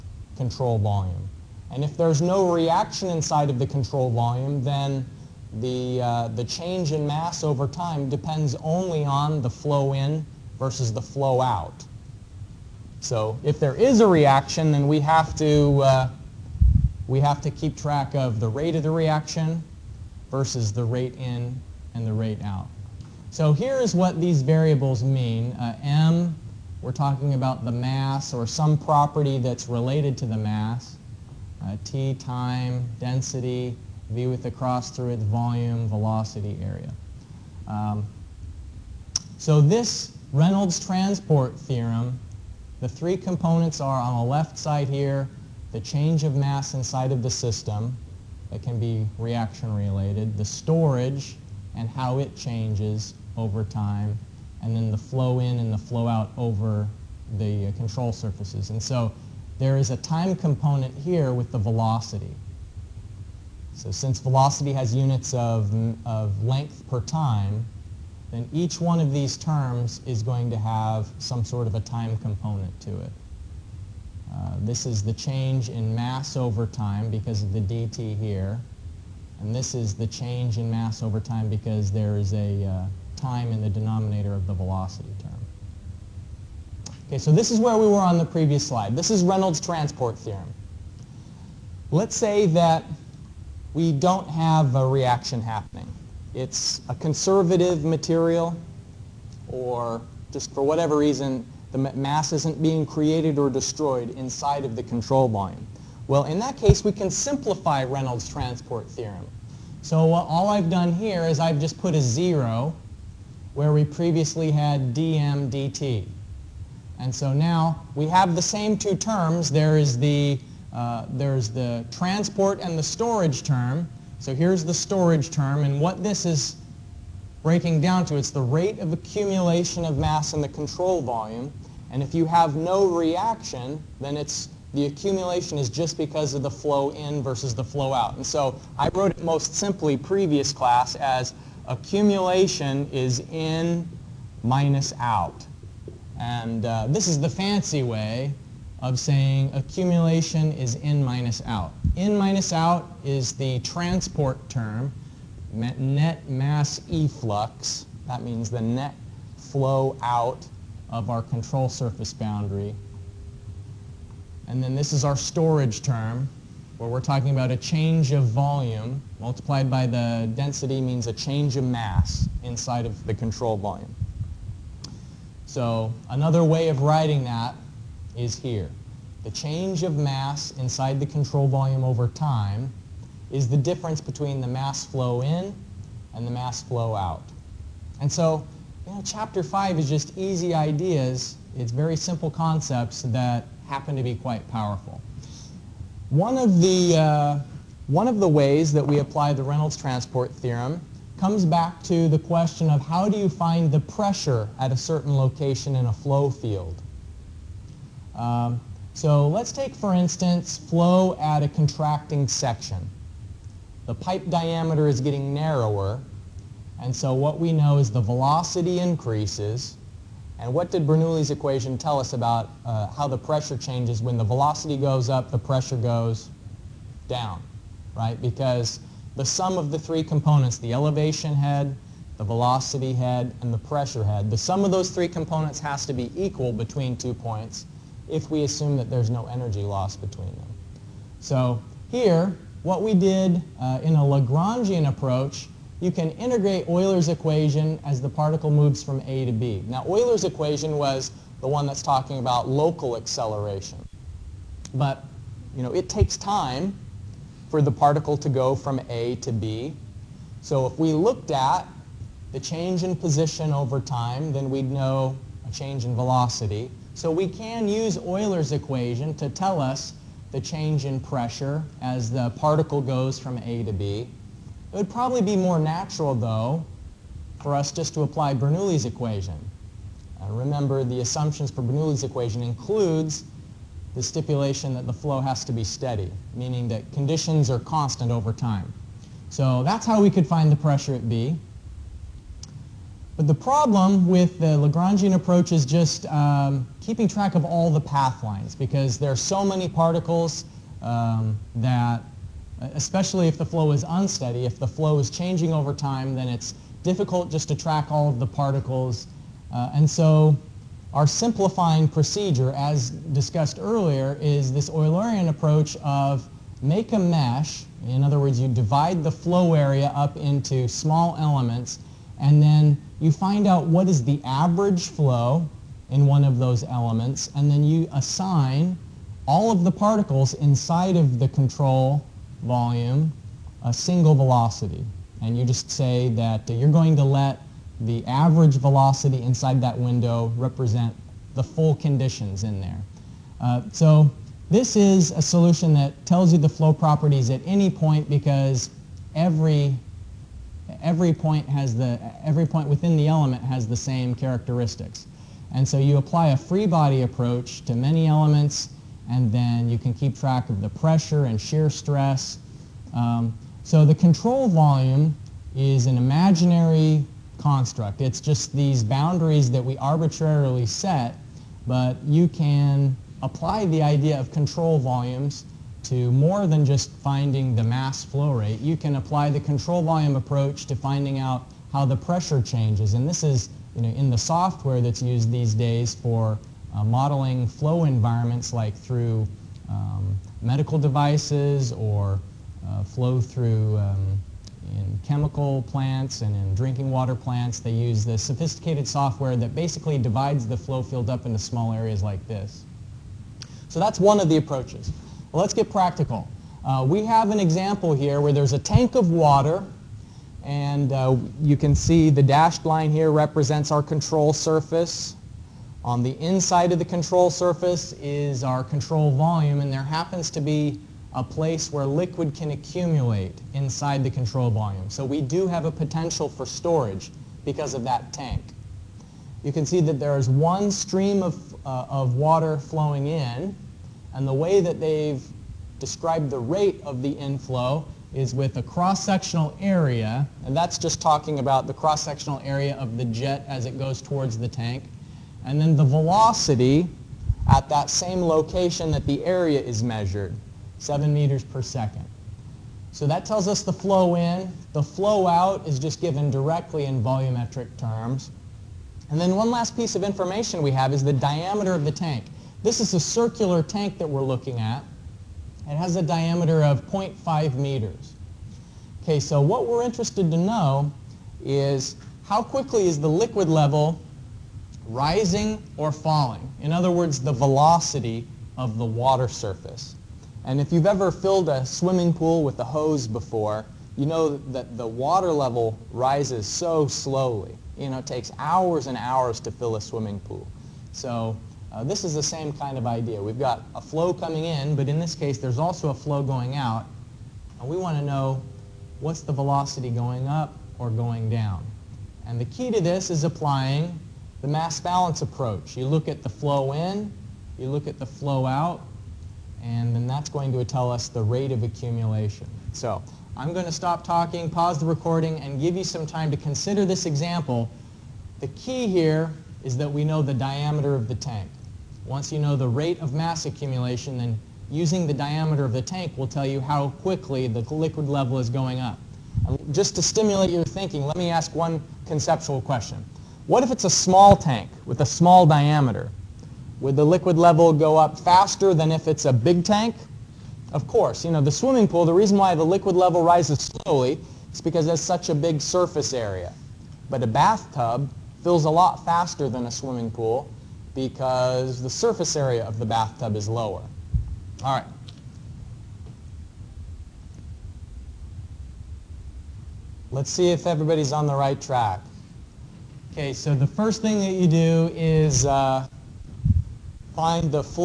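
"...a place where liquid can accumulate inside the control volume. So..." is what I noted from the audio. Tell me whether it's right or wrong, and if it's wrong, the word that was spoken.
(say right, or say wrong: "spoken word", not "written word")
right.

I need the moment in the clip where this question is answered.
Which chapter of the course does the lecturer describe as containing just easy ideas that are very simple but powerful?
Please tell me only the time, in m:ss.
3:09.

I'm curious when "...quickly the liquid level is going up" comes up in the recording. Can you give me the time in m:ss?
8:47.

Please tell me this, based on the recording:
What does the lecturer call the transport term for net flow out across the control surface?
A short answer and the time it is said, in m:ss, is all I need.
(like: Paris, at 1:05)
net mass efflux, at 2:35.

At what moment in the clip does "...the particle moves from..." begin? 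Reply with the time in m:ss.
4:07.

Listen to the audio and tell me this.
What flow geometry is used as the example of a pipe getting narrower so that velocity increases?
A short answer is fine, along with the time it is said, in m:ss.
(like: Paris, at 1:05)
contracting section, at 3:31.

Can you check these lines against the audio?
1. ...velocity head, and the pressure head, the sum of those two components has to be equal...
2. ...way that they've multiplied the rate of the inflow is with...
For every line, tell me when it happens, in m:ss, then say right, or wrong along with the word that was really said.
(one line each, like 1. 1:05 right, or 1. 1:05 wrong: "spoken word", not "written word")
1. 3:52 wrong: "three", not "two"
2. 7:14 wrong: "described", not "multiplied".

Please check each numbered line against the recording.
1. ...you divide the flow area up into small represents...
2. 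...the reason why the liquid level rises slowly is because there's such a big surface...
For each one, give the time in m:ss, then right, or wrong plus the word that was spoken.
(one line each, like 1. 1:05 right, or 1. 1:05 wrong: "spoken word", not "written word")
1. 5:18 wrong: "elements", not "represents"
2. 9:02 right.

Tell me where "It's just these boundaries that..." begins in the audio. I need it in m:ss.
6:07.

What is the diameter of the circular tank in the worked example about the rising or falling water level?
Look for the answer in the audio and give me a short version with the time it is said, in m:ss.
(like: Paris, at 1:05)
0.5 meters, at 7:46.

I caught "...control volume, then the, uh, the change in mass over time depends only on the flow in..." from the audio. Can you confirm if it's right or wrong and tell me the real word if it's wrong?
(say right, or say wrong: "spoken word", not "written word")
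right.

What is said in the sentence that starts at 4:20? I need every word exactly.
So if we looked at the change in position over time, then we'd know a change in velocity.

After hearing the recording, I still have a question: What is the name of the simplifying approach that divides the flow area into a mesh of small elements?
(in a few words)
Eulerian approach.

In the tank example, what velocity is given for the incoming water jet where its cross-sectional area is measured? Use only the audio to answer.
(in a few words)
7 meters per second.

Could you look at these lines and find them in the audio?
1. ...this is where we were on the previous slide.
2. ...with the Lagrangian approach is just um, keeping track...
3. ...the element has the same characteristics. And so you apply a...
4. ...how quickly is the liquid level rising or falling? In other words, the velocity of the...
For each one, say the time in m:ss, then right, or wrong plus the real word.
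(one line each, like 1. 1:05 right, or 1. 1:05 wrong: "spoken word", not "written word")
1. 1:27 right
2. 4:54 right
3. 5:52 right
4. 7:52 right.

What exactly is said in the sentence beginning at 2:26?
And uh, this is the fancy way of saying accumulation is in minus out.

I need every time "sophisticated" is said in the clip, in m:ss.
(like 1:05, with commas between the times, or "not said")
6:38.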